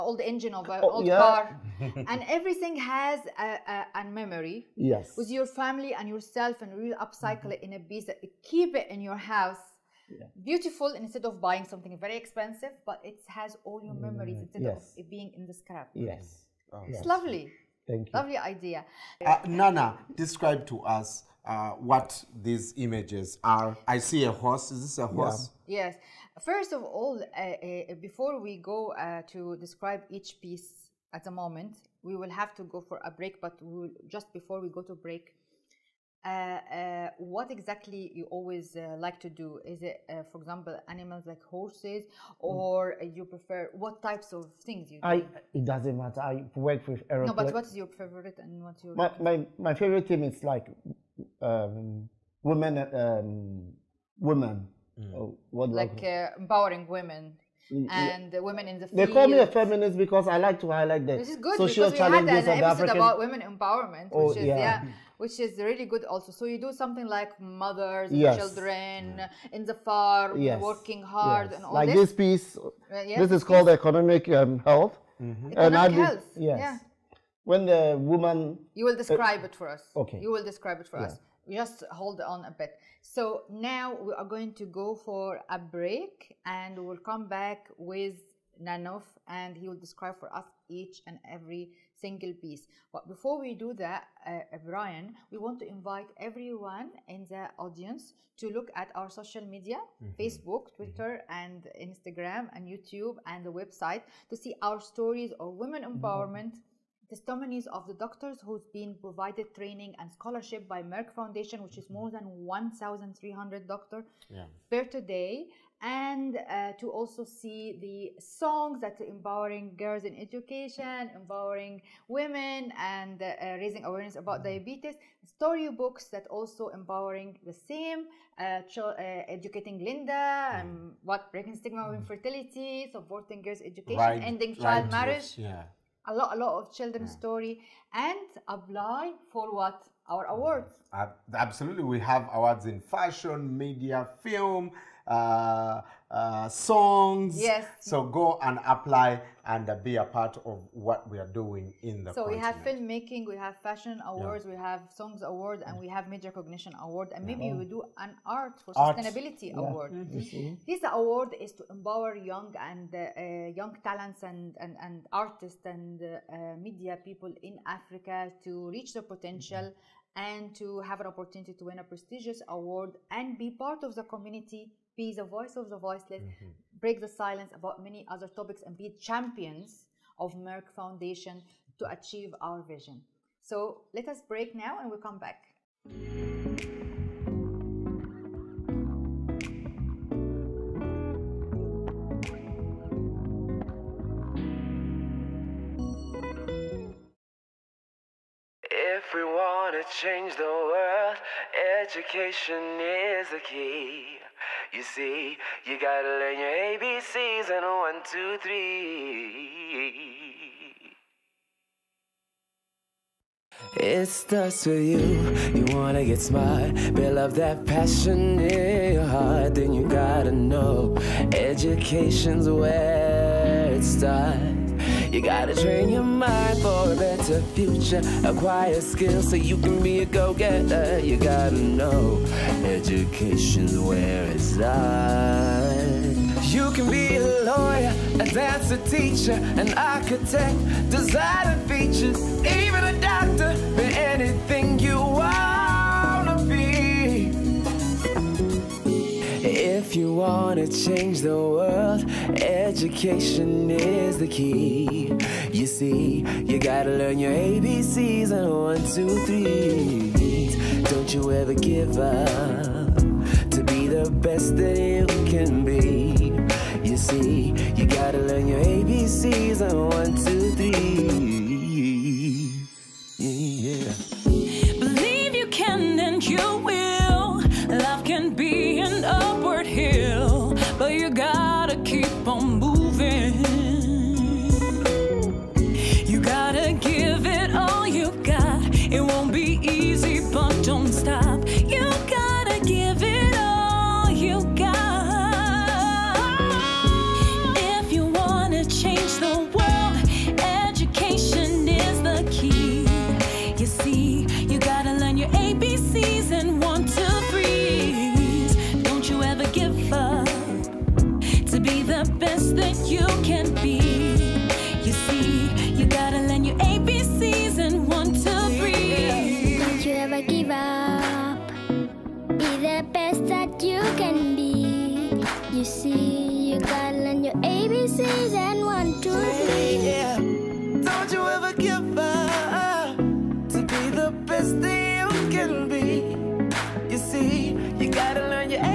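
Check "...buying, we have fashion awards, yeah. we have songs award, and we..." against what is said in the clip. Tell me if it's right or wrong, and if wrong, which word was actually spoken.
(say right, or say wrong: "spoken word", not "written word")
wrong: "filmmaking", not "buying".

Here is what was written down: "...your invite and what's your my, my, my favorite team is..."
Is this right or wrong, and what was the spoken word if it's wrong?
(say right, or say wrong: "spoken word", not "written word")
wrong: "favorite", not "invite".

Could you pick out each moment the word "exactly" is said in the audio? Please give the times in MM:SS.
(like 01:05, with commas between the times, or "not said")
00:37.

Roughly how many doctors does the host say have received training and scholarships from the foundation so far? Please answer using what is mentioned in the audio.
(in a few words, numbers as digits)
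1,300.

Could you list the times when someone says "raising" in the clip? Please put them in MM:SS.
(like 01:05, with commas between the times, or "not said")
02:03.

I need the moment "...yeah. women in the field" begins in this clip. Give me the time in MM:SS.
00:58.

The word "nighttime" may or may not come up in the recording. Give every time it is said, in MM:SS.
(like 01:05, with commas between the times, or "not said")
not said.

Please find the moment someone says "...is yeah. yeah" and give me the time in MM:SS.
01:04.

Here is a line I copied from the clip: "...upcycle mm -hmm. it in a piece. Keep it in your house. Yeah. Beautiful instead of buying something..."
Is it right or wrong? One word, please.
right.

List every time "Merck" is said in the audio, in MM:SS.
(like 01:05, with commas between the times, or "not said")
01:50, 03:00.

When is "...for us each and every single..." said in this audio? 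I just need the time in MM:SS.
01:30.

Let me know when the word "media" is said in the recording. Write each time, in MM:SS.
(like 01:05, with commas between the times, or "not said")
01:39, 02:23, 02:46.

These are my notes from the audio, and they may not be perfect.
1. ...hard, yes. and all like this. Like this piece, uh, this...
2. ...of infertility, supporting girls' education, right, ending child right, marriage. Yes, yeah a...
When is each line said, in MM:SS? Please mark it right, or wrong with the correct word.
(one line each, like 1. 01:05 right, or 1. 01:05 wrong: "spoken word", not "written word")
1. 01:11 right
2. 02:11 right.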